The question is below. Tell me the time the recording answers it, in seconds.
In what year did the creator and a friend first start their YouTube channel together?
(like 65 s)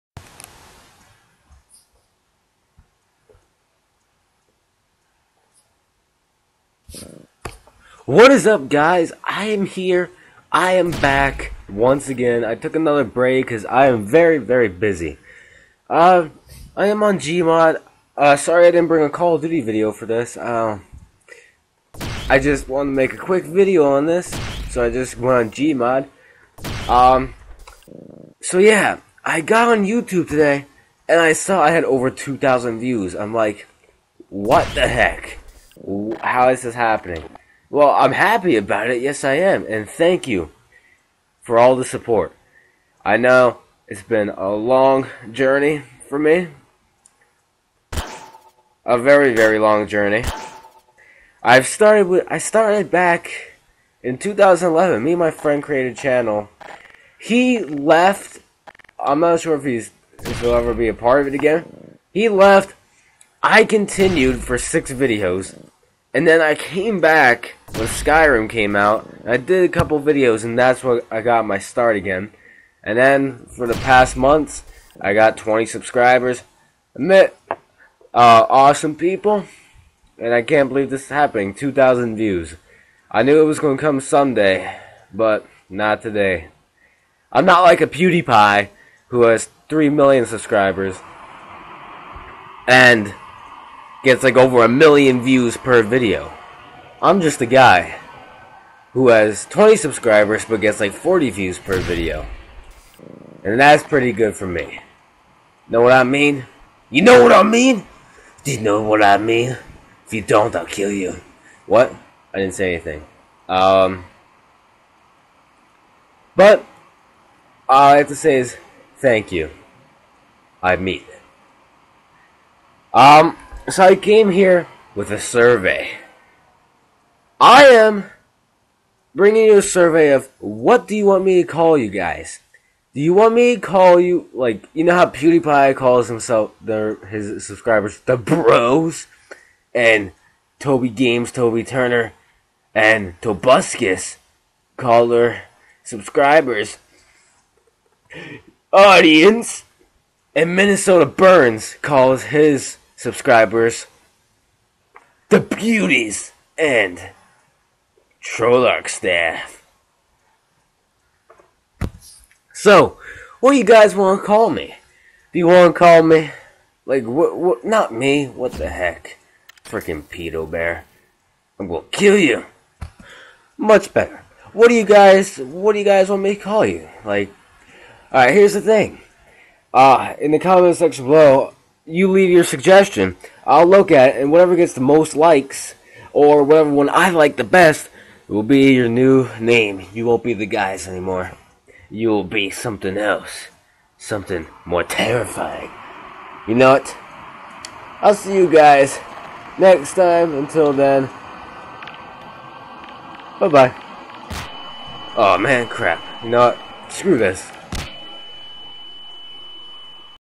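54 s.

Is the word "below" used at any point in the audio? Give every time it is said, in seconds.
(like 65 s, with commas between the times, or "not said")
181 s.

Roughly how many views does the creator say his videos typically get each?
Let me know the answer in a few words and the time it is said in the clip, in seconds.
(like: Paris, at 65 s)
40, at 100 s.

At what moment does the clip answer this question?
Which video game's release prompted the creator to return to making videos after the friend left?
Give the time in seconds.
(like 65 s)
67 s.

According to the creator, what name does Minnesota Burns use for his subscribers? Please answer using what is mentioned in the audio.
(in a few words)
the beauties.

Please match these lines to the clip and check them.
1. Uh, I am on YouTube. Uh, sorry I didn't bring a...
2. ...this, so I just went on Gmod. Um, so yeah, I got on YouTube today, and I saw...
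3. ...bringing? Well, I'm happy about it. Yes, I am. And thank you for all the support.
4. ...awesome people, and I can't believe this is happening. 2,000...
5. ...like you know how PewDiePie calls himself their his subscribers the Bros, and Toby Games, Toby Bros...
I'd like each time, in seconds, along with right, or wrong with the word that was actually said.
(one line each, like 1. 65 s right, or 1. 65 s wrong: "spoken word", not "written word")
1. 15 s wrong: "Gmod", not "YouTube"
2. 24 s right
3. 36 s wrong: "happening", not "bringing"
4. 78 s right
5. 134 s wrong: "Turner", not "Bros".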